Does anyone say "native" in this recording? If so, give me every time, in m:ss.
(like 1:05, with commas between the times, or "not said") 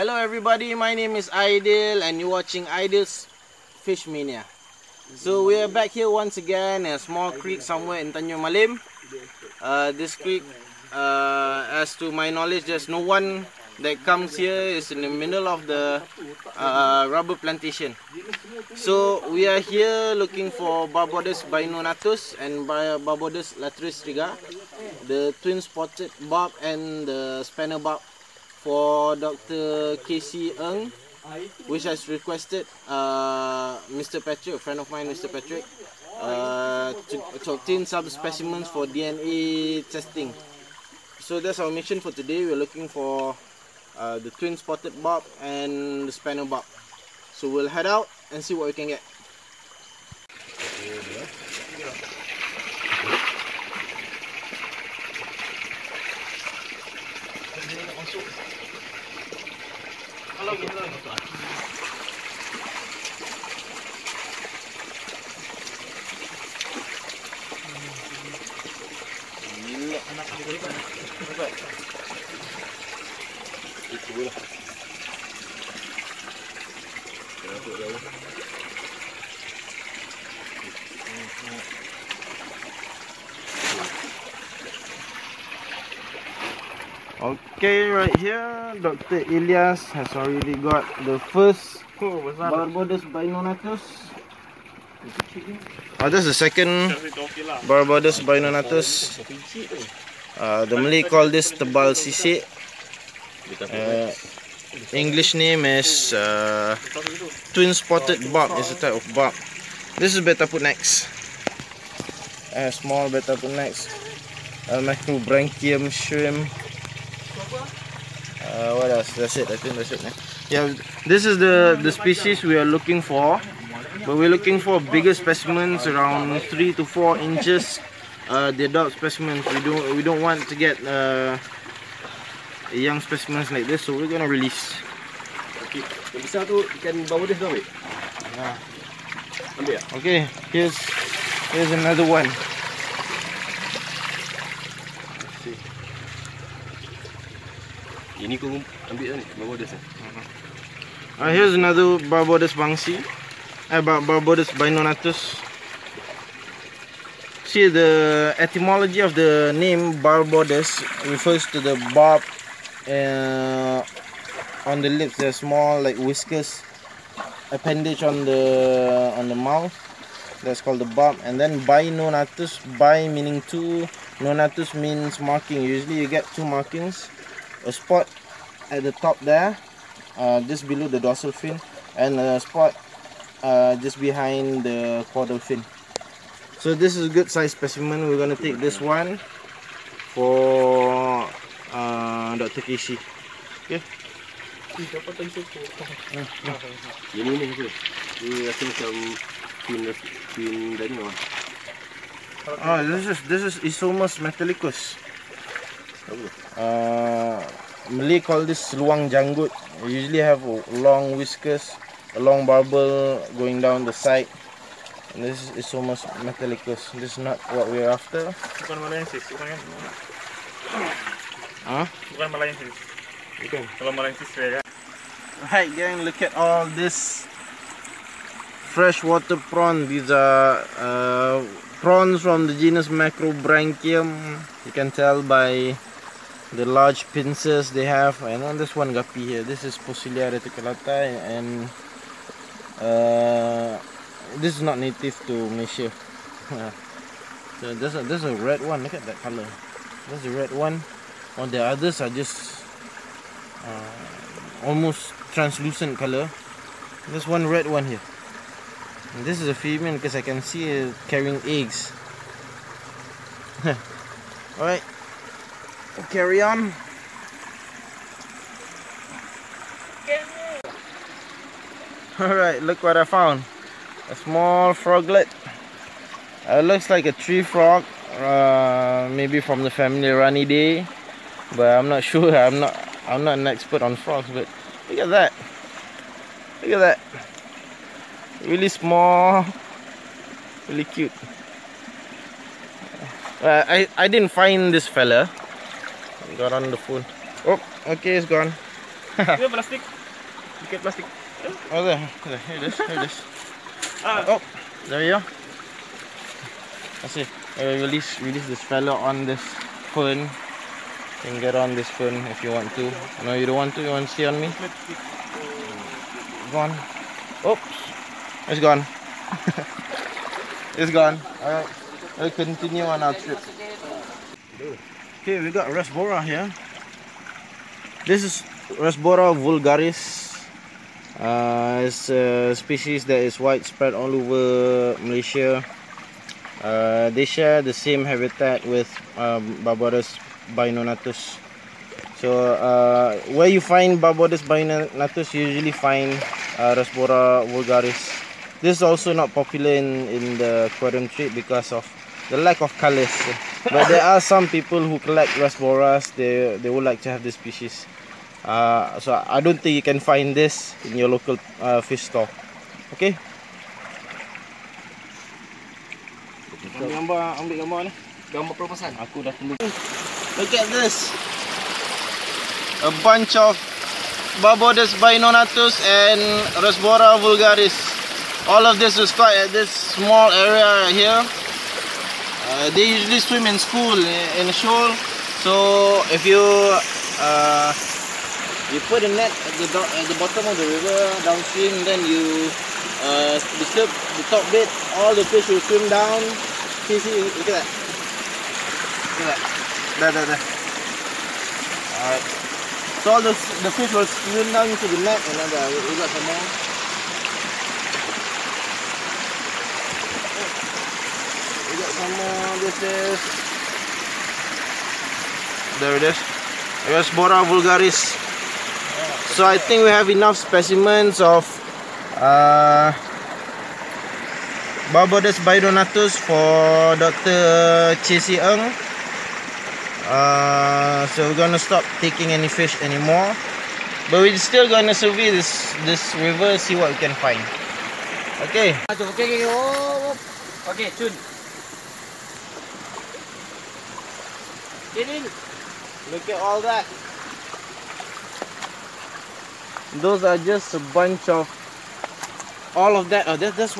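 4:04.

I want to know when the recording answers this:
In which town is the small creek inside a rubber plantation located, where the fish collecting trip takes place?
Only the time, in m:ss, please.
0:08.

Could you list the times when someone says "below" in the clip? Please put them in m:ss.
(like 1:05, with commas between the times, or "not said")
3:00.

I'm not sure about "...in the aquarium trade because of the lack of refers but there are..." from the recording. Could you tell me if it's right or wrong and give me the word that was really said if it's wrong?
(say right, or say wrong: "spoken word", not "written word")
wrong: "colors", not "refers".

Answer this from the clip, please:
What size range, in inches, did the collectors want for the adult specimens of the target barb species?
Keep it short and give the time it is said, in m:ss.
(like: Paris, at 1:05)
3 to 4 inches, at 2:06.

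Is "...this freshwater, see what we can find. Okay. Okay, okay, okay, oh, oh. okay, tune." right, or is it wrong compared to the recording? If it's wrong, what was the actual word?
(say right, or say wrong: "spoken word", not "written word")
wrong: "river", not "freshwater".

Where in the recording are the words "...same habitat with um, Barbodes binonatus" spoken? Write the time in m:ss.
5:37.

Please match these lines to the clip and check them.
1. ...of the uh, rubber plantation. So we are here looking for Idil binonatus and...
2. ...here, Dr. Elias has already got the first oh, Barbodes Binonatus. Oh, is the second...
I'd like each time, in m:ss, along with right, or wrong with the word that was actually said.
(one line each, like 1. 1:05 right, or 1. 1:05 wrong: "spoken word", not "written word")
1. 0:15 wrong: "Barbodus", not "Idil"
2. 1:28 right.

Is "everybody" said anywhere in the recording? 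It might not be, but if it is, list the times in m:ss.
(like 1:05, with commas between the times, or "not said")
0:00.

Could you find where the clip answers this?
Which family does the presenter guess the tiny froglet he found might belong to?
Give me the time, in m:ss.
4:40.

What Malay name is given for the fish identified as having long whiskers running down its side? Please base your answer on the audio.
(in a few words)
luang janggut.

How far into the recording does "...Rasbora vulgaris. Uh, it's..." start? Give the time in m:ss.
5:28.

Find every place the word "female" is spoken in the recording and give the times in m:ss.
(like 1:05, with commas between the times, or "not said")
4:19.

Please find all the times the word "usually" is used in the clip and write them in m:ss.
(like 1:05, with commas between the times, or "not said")
2:55, 3:29, 5:45, 6:22.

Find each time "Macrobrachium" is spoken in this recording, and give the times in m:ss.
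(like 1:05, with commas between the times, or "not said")
1:54, 3:52.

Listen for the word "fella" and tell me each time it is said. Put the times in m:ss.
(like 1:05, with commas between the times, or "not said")
4:54, 5:08.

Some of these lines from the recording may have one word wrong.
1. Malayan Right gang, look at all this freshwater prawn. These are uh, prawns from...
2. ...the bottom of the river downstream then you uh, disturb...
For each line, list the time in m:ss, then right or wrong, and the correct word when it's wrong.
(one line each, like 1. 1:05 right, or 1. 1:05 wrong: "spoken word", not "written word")
1. 3:43 right
2. 6:30 right.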